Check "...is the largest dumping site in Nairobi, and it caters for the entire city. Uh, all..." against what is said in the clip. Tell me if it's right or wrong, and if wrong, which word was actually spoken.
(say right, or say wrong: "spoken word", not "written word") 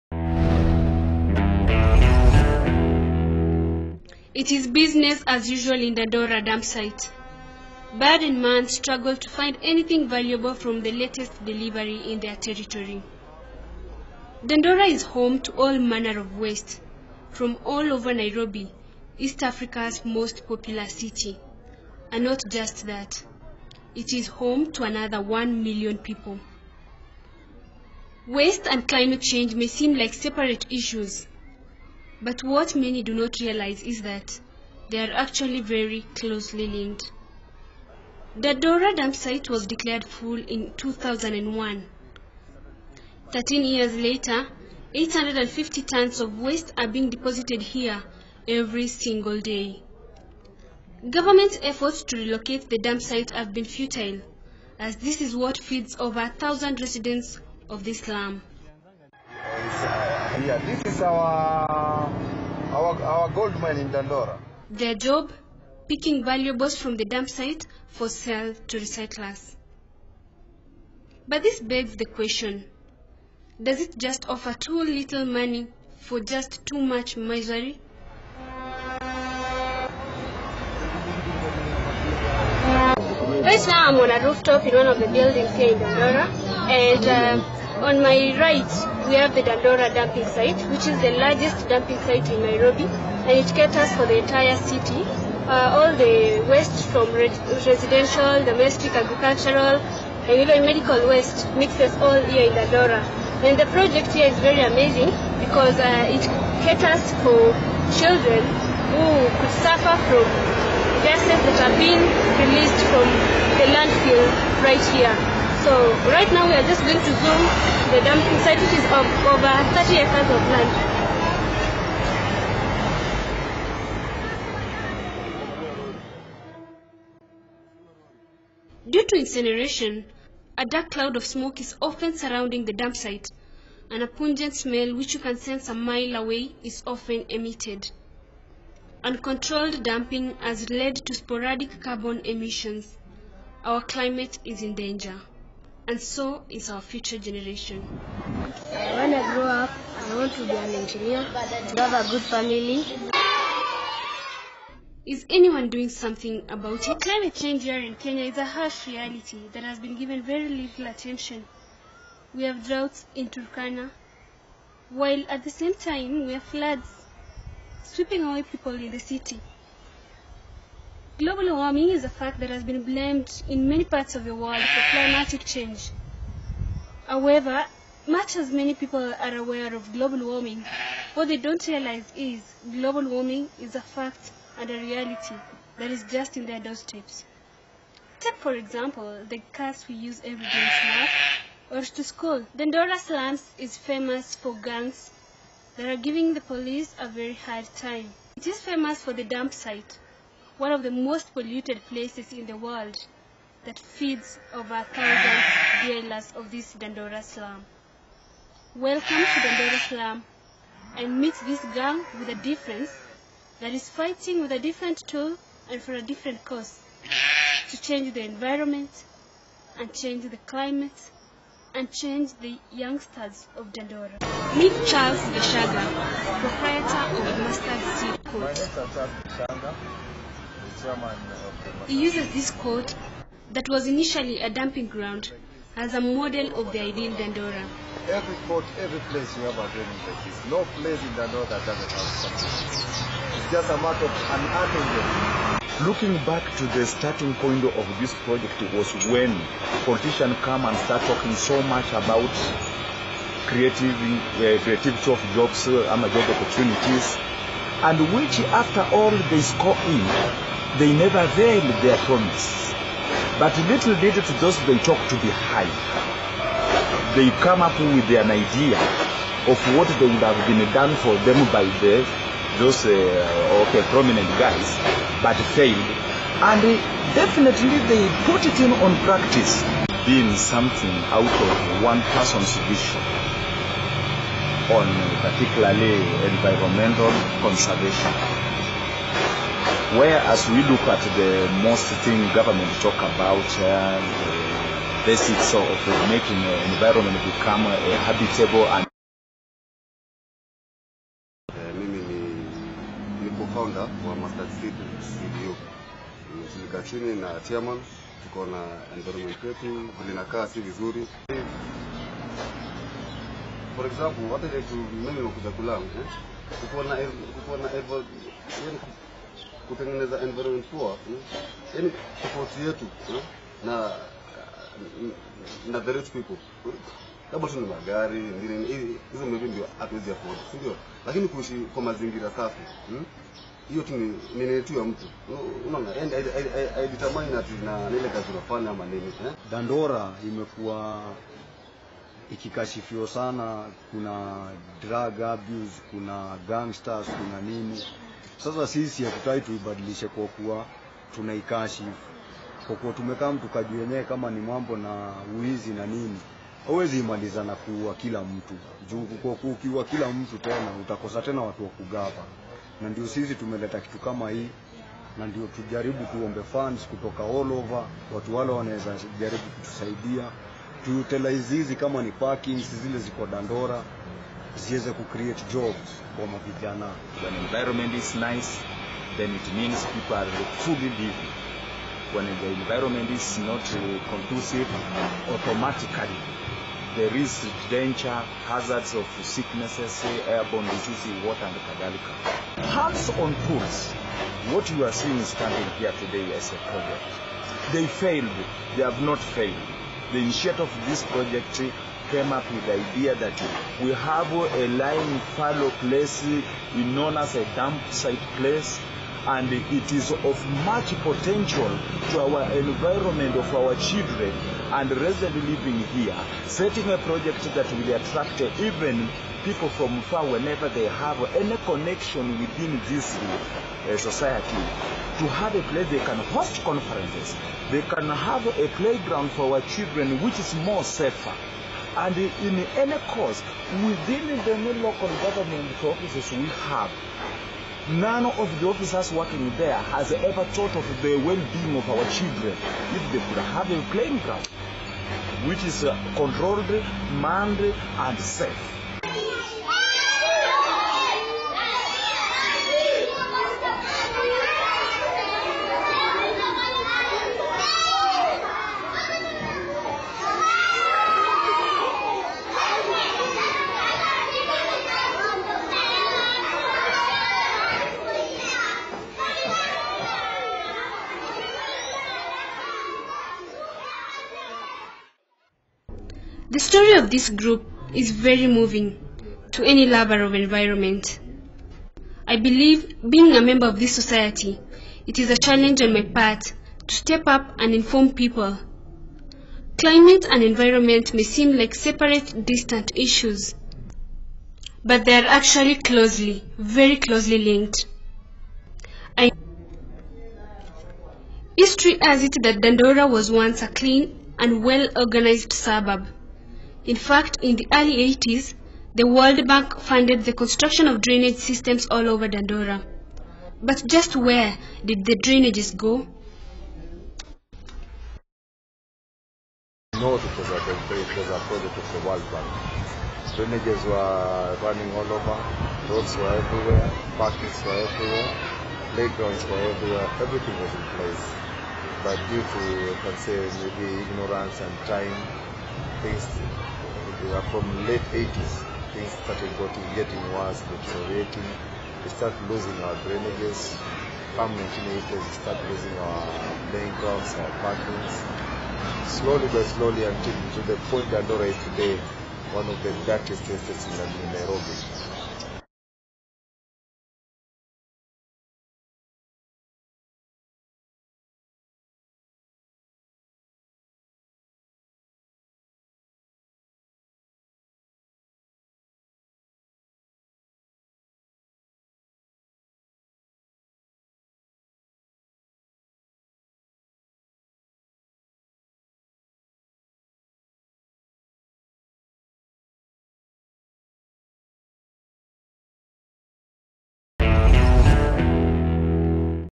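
right.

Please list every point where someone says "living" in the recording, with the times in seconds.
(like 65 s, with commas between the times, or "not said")
380 s, 415 s.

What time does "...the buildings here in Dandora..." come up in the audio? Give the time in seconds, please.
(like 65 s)
84 s.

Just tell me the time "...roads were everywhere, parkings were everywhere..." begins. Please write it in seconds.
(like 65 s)
525 s.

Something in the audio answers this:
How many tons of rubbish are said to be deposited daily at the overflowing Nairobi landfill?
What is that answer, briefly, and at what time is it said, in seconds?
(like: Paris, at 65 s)
850, at 44 s.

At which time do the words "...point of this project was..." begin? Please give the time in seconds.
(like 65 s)
247 s.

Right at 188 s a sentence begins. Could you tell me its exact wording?
Take, for example, the cars we use every day to work or to school.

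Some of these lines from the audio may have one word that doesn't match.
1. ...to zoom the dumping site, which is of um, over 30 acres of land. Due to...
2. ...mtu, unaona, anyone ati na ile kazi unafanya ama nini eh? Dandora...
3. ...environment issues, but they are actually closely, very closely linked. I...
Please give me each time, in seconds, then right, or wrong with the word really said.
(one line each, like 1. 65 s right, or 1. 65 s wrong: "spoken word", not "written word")
1. 116 s right
2. 334 s wrong: "haidetermine", not "anyone"
3. 492 s wrong: "distant", not "environment".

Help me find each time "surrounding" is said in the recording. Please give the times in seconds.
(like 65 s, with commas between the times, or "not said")
132 s.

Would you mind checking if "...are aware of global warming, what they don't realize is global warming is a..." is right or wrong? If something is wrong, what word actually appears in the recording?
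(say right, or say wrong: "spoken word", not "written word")
right.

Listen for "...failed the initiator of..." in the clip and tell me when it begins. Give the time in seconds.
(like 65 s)
399 s.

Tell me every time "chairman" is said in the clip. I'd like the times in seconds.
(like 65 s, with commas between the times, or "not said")
230 s, 307 s.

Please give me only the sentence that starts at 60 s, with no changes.
yeah, this is our, our, our gold mine in Dandora.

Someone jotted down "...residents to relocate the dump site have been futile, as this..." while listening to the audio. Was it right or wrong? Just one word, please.
wrong.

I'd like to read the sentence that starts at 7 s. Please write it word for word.
Bird and man struggle to find anything valuable from the latest delivery in their territory.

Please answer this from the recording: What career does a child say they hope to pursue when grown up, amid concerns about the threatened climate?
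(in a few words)
Engineer.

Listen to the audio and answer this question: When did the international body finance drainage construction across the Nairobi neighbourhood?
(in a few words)
Early 80s.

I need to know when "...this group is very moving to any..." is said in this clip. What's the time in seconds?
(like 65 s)
477 s.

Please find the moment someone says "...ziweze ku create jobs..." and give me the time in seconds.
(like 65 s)
374 s.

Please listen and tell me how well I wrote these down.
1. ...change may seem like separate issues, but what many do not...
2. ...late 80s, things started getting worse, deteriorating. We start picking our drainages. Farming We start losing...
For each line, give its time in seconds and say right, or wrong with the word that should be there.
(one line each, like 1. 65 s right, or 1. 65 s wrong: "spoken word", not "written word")
1. 29 s right
2. 537 s wrong: "losing", not "picking".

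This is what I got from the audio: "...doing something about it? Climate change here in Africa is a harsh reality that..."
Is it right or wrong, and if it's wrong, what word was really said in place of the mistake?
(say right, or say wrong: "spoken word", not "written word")
wrong: "Kenya", not "Africa".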